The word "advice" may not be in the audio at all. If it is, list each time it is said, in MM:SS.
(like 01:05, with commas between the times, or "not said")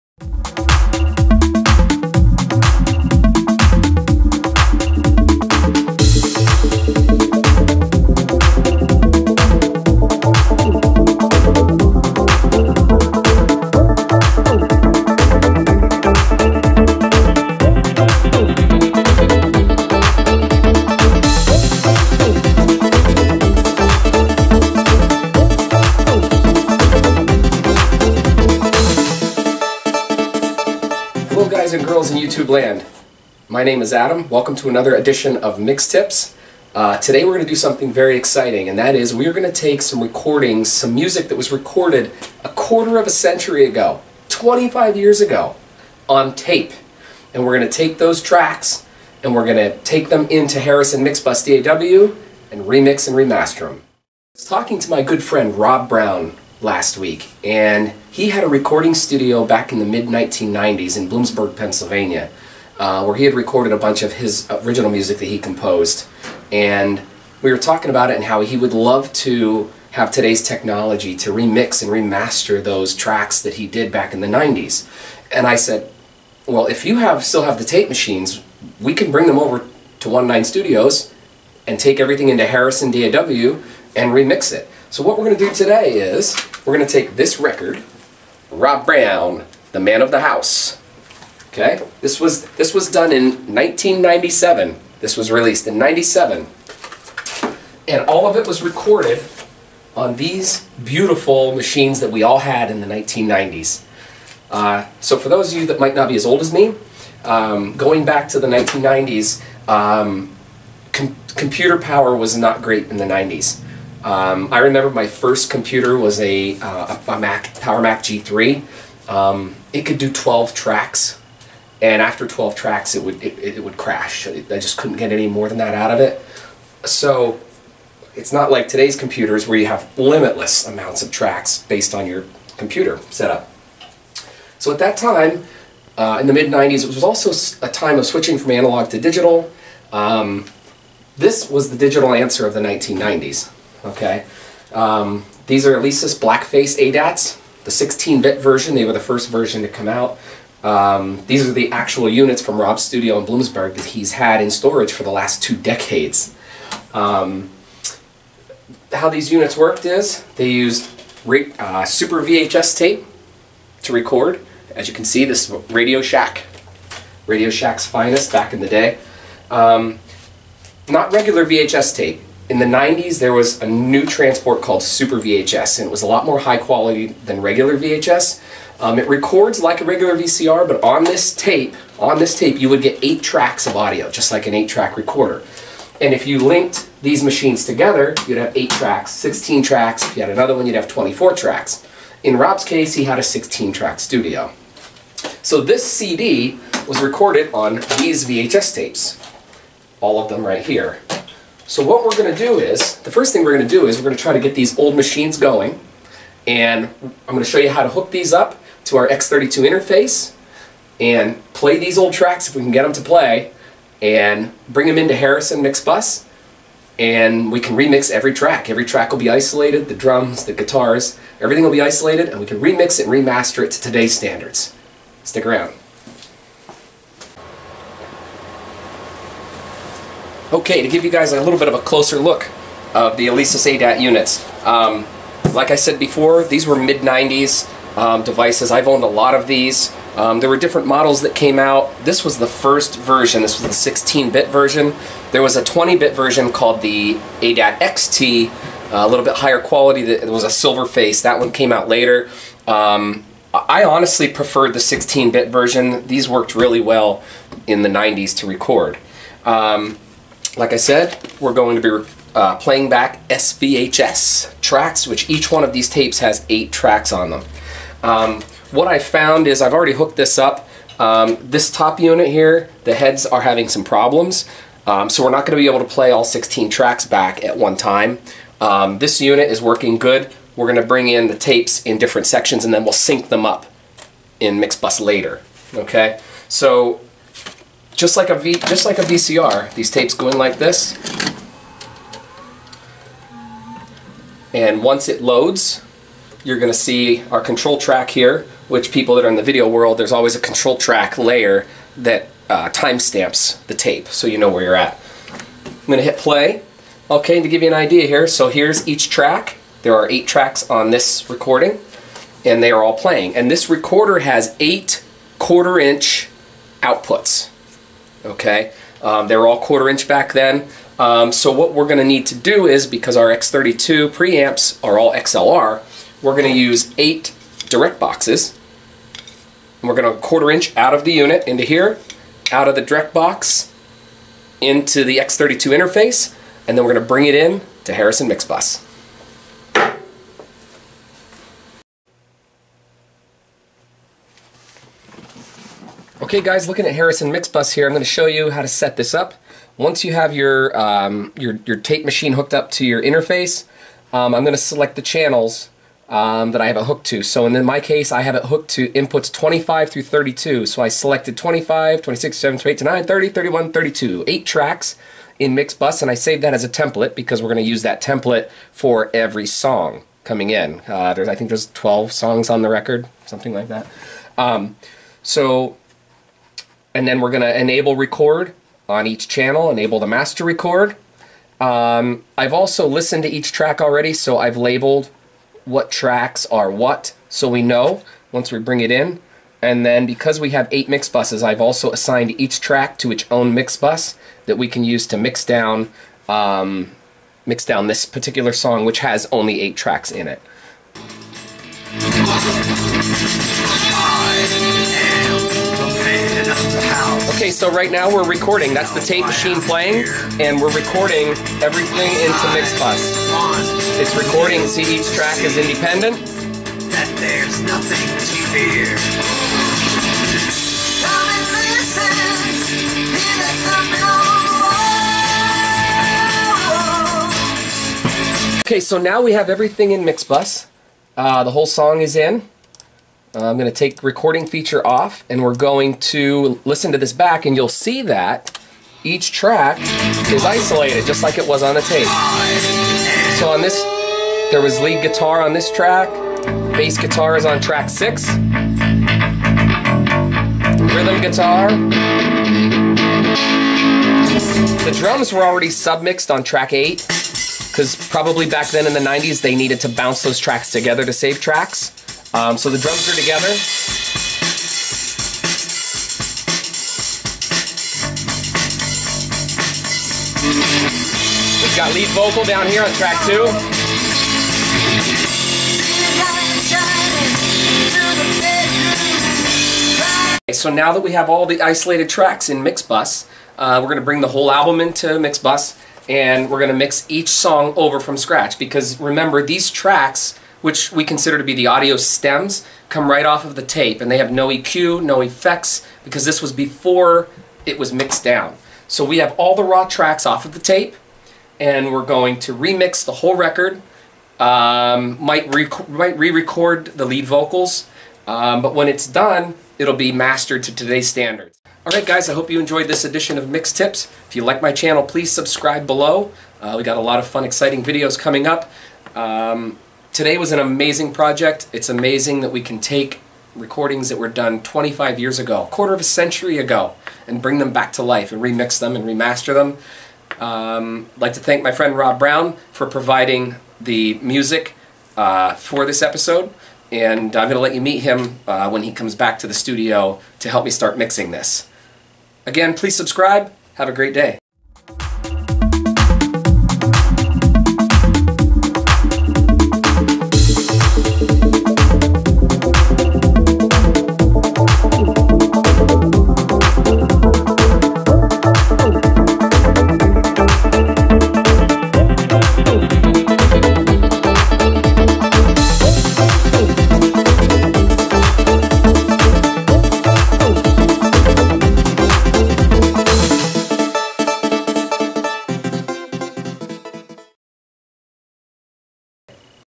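not said.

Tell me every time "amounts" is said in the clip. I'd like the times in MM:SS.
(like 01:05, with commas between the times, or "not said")
02:10.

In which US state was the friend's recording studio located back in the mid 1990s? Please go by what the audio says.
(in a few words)
Pennsylvania.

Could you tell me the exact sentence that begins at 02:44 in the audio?
As you can see, this is Radio Shack.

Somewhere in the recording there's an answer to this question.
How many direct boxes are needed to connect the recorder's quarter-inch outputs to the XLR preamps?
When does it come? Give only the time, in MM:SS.
05:26.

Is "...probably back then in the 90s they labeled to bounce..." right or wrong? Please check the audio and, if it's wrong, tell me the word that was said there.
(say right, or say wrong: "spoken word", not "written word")
wrong: "needed", not "labeled".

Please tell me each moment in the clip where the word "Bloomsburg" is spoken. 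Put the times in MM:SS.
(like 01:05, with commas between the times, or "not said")
01:01, 02:33.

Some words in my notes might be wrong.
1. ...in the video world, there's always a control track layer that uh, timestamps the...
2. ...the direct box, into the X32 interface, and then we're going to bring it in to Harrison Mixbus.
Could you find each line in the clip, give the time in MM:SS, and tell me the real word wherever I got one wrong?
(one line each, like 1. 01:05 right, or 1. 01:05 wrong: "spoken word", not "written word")
1. 04:59 right
2. 05:32 right.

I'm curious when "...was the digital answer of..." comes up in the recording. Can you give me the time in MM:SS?
02:21.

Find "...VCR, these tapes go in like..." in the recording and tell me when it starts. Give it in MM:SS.
04:49.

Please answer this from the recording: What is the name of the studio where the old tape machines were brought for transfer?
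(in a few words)
One Nine Studios.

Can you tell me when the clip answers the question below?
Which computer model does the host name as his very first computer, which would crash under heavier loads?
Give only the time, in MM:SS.
01:57.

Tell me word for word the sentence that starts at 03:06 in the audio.
And if you linked these machines together, you'd have 8 tracks, 16 tracks.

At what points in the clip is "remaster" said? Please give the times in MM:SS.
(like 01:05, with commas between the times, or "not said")
00:53, 01:11, 03:43, 08:49.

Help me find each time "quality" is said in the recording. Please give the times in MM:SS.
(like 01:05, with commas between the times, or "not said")
02:56, 04:09.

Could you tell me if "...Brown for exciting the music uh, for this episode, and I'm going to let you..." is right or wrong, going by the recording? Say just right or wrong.
wrong.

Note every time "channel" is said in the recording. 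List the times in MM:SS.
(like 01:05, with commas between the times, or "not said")
05:55, 06:19, 08:34.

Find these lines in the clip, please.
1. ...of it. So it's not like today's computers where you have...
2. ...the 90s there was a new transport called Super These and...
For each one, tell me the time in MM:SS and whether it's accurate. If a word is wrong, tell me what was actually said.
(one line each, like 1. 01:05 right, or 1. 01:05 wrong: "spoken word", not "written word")
1. 02:05 right
2. 02:52 wrong: "VHS", not "These".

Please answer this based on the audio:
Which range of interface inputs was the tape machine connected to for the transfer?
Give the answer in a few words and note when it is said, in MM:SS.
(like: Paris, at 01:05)
25 through 32, at 05:59.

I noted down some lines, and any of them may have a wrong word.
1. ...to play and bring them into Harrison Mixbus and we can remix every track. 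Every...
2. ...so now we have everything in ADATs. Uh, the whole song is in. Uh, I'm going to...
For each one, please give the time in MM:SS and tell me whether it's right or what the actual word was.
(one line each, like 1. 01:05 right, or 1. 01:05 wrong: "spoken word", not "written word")
1. 03:32 right
2. 07:08 wrong: "Mixbus", not "ADATs".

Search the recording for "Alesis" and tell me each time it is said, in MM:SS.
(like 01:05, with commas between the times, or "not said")
02:25, 03:53.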